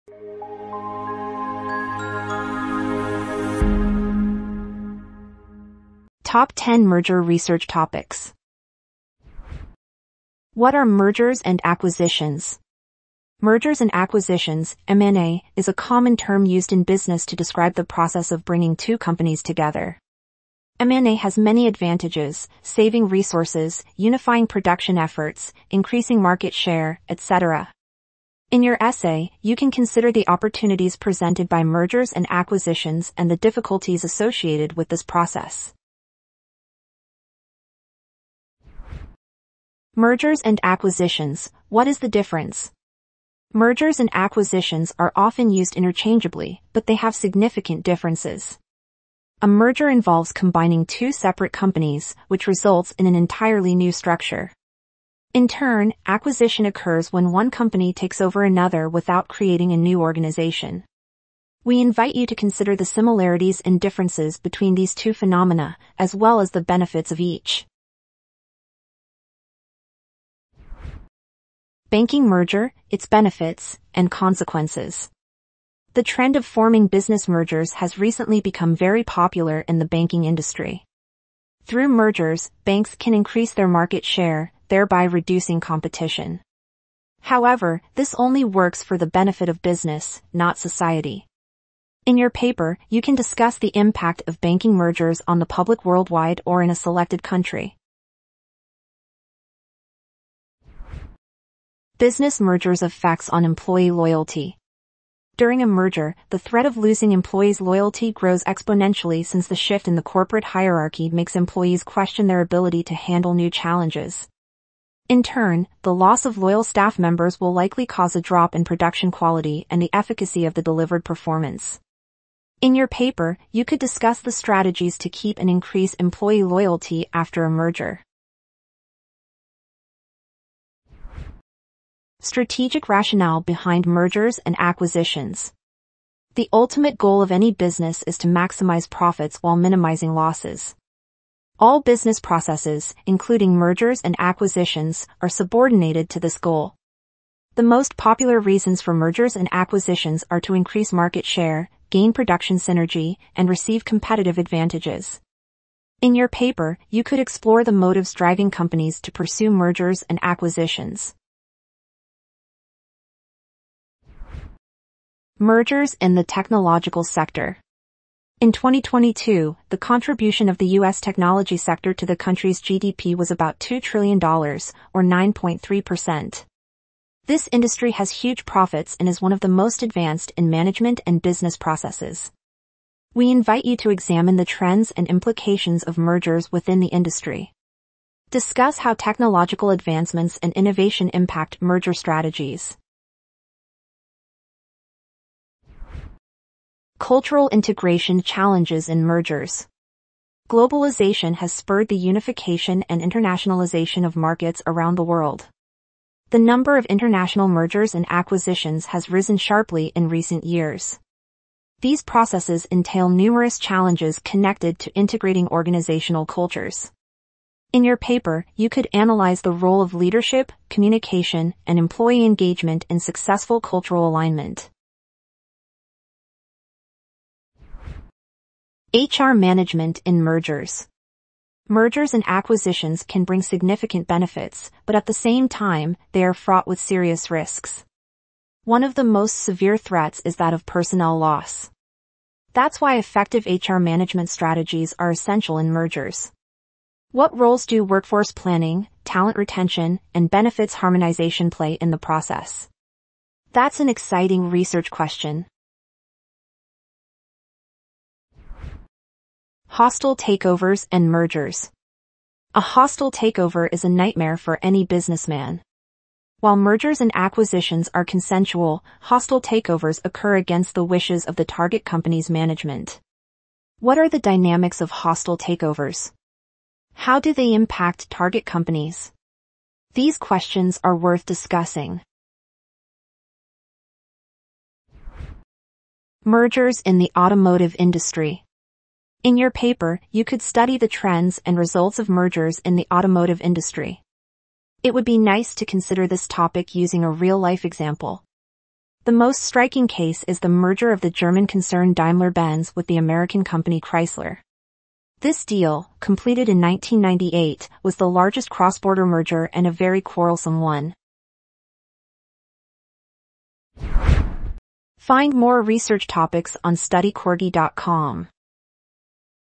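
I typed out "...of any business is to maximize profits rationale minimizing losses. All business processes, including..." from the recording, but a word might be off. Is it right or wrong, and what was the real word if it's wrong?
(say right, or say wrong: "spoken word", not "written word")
wrong: "while", not "rationale".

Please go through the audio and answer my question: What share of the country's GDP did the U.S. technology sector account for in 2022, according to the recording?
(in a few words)
9.3%.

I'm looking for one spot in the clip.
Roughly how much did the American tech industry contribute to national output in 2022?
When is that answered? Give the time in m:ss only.
2:53.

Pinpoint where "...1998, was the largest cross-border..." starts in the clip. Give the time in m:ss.
5:06.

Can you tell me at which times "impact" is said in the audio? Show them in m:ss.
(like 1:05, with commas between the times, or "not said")
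1:33, 3:11, 4:37.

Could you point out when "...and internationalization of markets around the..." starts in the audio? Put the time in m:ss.
3:22.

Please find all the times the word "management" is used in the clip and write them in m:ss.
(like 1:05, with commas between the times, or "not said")
3:00, 3:49, 4:03, 4:32.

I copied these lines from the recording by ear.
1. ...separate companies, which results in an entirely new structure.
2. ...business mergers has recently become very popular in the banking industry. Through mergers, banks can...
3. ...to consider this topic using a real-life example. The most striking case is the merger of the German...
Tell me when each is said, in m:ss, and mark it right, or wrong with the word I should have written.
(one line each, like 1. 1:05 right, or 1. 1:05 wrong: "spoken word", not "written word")
1. 0:51 right
2. 1:16 right
3. 4:55 right.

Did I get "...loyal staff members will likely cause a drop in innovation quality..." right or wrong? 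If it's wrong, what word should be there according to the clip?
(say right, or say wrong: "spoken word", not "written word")
wrong: "production", not "innovation".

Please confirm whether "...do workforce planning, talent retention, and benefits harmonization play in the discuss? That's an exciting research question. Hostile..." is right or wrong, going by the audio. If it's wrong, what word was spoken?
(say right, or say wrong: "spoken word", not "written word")
wrong: "process", not "discuss".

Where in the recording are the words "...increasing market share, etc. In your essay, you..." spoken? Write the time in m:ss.
0:25.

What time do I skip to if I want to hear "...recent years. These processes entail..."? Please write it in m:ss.
3:30.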